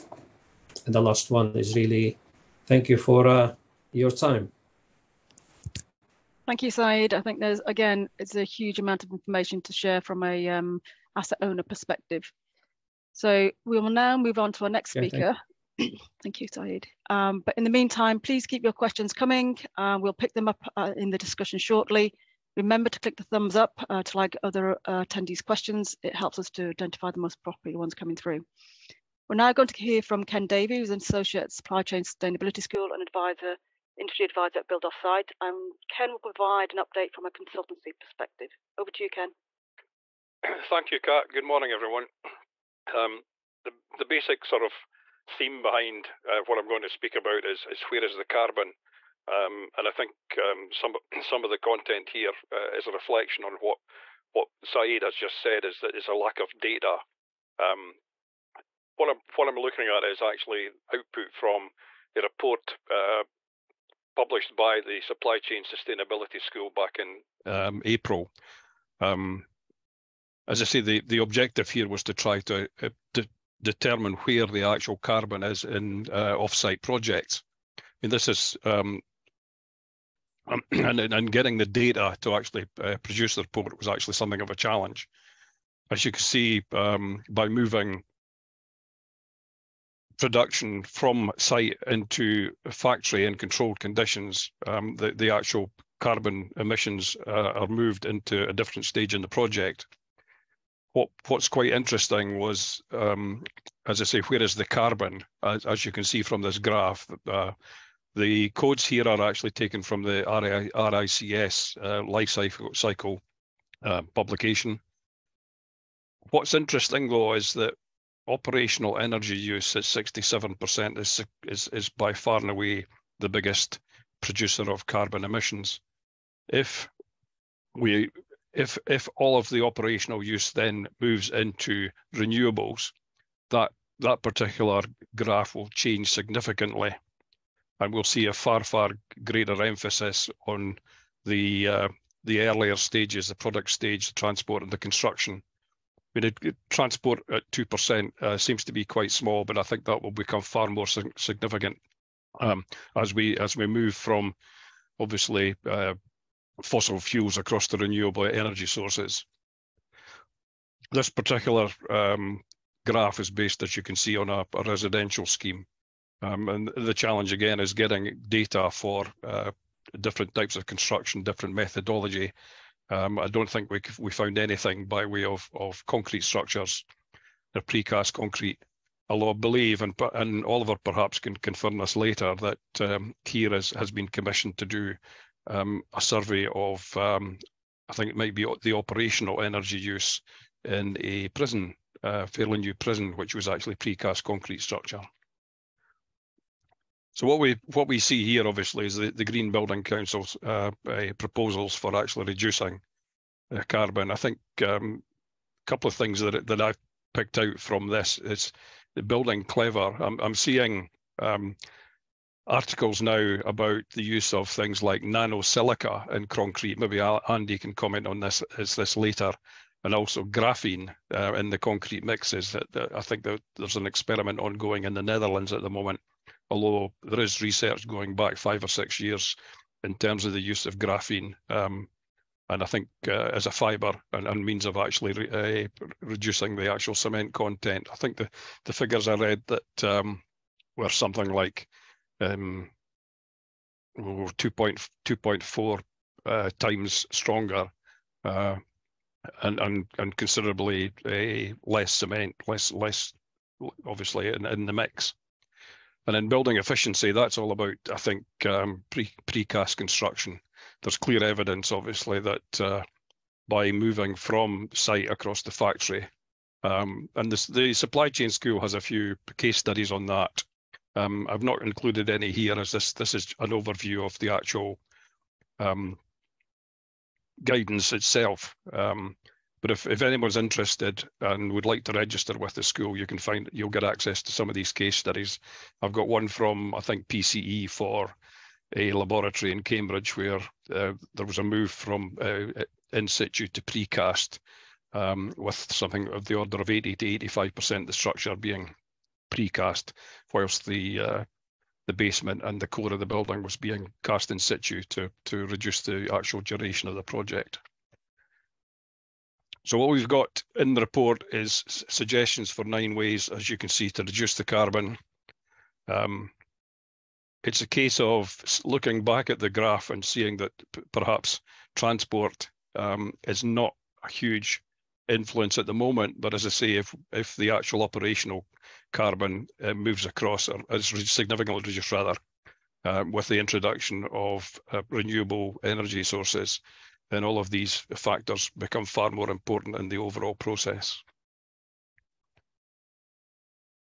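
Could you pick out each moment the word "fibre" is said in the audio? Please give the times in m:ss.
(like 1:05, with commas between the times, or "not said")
3:53.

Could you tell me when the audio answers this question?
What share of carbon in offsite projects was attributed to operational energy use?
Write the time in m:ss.
1:59.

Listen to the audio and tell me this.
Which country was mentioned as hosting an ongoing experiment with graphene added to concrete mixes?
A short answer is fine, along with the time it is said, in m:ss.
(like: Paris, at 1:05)
Netherlands, at 3:45.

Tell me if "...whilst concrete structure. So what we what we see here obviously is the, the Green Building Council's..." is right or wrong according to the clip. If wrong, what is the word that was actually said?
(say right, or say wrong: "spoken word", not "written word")
wrong: "precast", not "whilst".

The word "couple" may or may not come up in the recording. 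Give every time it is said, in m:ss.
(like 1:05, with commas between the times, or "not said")
3:25.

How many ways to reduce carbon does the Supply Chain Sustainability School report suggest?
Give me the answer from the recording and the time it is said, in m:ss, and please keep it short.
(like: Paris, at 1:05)
9, at 5:12.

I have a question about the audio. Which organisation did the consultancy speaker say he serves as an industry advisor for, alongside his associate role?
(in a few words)
Build Offsite.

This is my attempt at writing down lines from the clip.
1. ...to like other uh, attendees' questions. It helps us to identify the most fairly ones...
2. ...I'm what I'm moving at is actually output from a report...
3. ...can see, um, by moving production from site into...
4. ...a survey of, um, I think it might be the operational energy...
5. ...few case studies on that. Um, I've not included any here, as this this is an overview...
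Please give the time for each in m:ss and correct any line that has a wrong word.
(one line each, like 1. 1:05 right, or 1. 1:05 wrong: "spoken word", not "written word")
1. 0:24 wrong: "properly", not "fairly"
2. 0:59 wrong: "looking", not "moving"
3. 1:26 right
4. 3:05 right
5. 4:28 right.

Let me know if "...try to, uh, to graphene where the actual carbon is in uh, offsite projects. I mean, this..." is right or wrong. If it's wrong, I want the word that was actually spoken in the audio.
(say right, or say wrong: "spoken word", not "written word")
wrong: "determine", not "graphene".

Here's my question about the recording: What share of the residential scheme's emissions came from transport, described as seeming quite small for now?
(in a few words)
2%.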